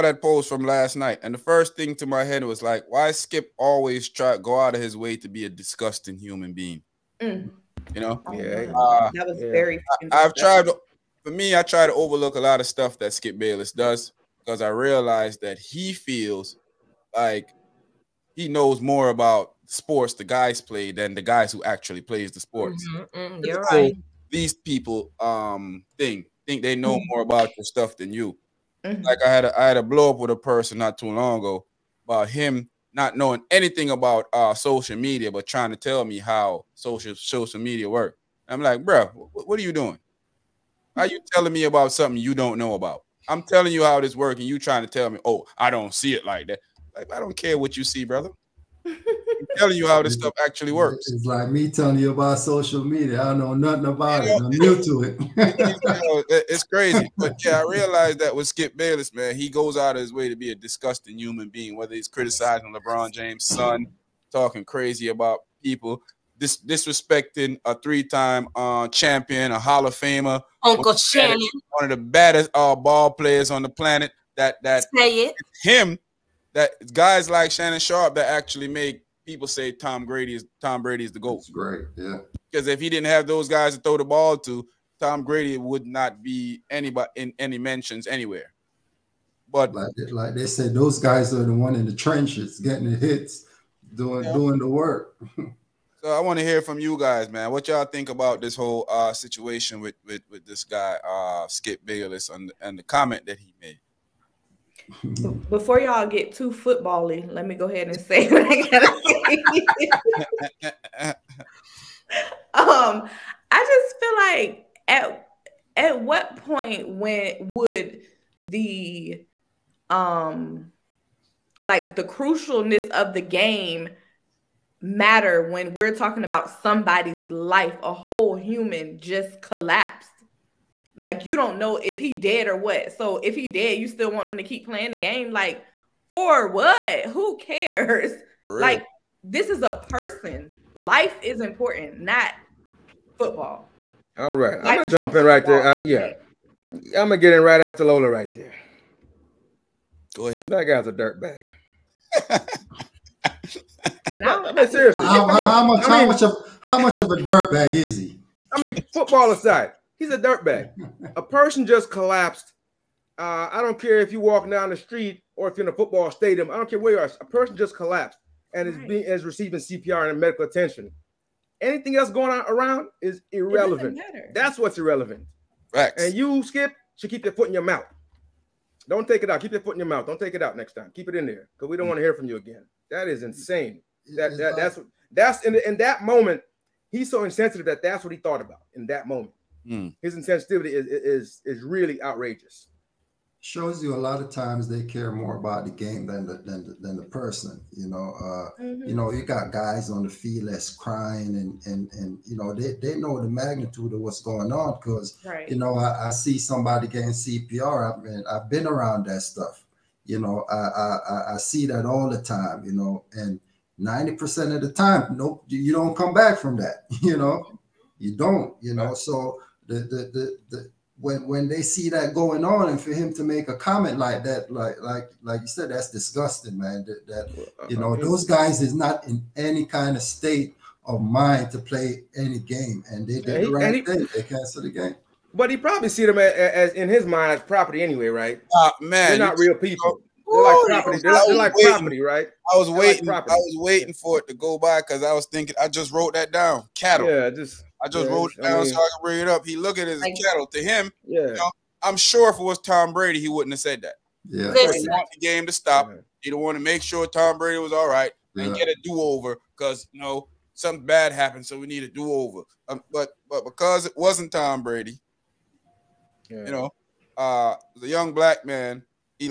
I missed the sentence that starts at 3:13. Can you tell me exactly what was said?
Shows you a lot of times they care more about the game than the than the, than the person.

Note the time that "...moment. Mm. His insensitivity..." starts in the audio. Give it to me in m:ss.
3:09.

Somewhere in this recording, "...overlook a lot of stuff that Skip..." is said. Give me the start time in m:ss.
0:11.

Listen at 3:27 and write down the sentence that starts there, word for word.
I've been I've been around that stuff.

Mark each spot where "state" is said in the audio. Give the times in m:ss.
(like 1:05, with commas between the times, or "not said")
3:50.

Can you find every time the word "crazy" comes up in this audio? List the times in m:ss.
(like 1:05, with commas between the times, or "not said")
0:56, 1:04.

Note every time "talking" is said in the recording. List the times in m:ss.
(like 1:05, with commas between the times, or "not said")
1:04, 2:05.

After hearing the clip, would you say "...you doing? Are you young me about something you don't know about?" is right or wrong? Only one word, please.
wrong.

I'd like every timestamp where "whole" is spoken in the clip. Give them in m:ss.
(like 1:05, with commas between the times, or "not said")
1:38, 2:07.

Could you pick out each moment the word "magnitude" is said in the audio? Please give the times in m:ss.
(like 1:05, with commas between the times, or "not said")
3:23.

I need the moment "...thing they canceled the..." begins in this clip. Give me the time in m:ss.
3:53.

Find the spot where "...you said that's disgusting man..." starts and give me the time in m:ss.
3:45.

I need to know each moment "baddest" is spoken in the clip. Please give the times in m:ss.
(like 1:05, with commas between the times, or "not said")
1:12.